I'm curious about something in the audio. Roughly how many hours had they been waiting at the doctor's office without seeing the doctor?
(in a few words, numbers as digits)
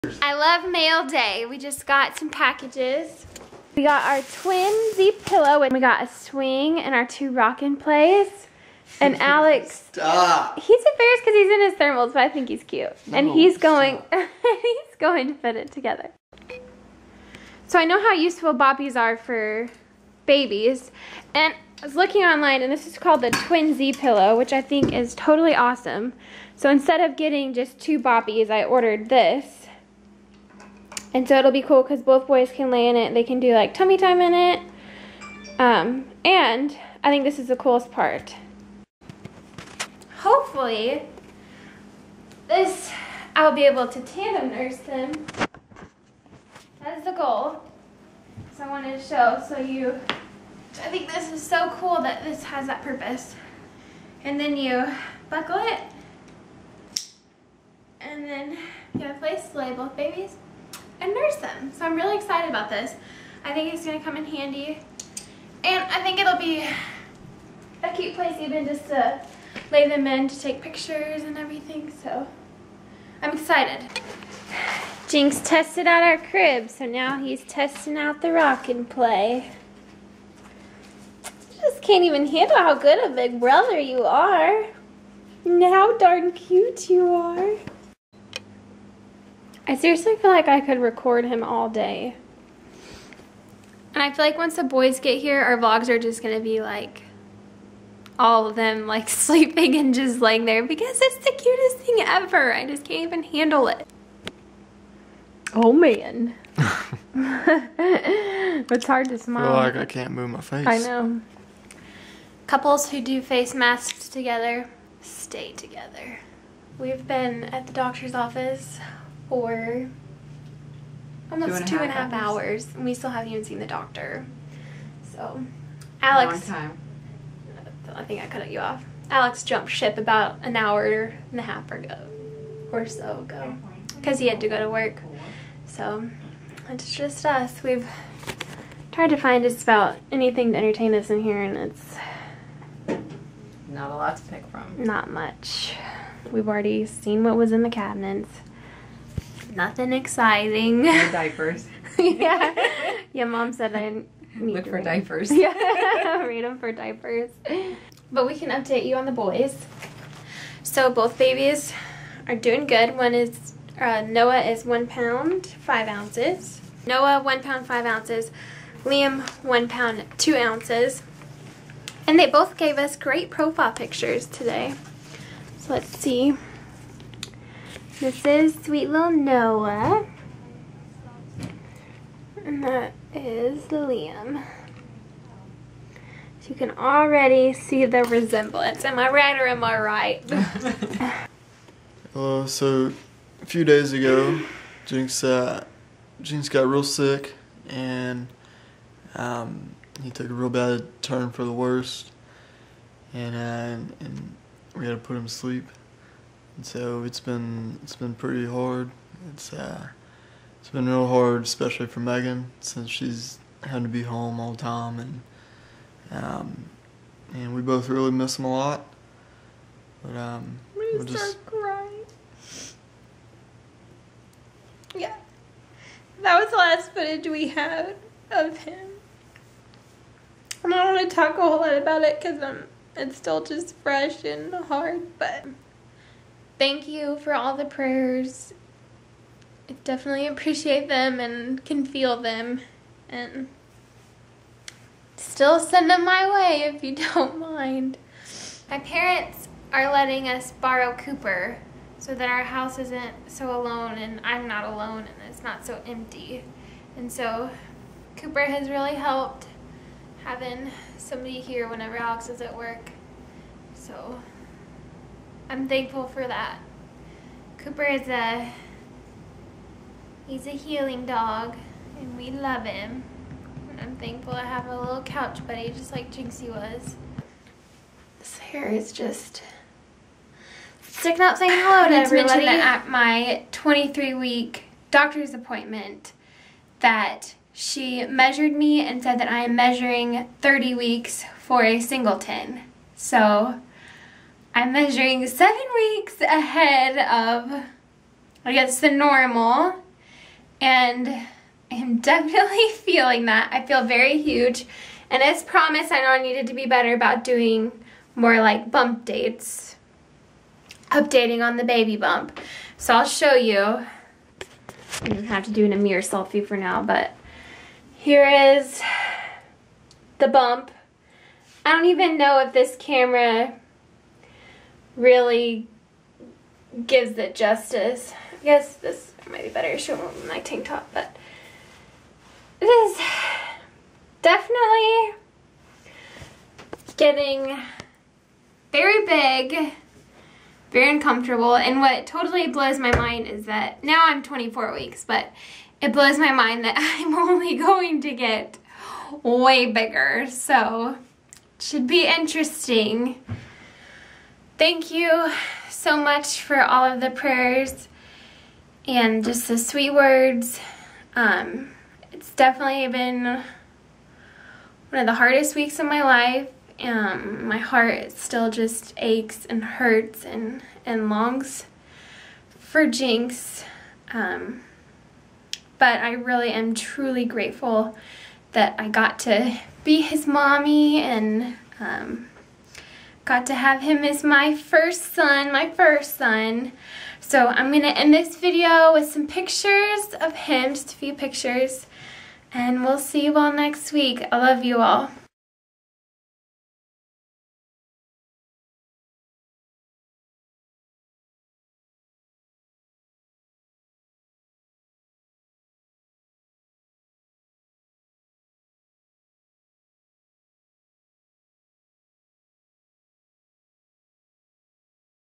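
2 and a half.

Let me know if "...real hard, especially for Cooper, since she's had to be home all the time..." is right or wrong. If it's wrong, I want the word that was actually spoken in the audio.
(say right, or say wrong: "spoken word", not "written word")
wrong: "Megan", not "Cooper".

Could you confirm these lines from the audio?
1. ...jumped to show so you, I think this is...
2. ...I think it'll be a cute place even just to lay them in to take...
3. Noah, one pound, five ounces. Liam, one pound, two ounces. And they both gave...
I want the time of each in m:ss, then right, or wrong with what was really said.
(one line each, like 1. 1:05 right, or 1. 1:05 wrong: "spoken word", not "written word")
1. 0:48 wrong: "wanted", not "jumped"
2. 1:05 right
3. 2:46 right.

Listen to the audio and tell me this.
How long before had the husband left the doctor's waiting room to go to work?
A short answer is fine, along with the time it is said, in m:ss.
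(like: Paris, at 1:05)
an hour and a half, at 2:10.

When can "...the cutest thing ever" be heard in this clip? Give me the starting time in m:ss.
1:41.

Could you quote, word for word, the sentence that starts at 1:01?
So I'm really excited about this.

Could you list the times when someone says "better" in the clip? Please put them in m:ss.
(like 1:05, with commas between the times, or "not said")
5:06, 5:29.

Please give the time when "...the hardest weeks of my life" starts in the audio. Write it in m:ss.
6:05.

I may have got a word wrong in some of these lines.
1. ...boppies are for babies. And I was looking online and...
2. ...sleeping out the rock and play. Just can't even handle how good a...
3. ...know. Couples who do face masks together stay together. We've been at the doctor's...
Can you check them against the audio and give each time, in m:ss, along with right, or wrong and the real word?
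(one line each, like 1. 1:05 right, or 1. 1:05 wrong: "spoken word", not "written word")
1. 0:18 right
2. 1:17 wrong: "testing", not "sleeping"
3. 1:50 right.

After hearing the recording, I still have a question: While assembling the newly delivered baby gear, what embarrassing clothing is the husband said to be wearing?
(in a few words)
thermals.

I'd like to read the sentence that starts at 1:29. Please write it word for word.
I seriously feel like I could record him all day.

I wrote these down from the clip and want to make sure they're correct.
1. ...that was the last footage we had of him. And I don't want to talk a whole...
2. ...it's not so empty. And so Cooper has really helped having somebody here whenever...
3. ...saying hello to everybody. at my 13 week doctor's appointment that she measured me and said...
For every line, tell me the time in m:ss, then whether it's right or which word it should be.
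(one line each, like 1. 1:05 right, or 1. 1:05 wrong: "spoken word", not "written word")
1. 3:46 right
2. 4:15 right
3. 4:41 wrong: "23", not "13".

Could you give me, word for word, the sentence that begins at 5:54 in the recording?
Thank you so much for all of the prayers and just the sweet words.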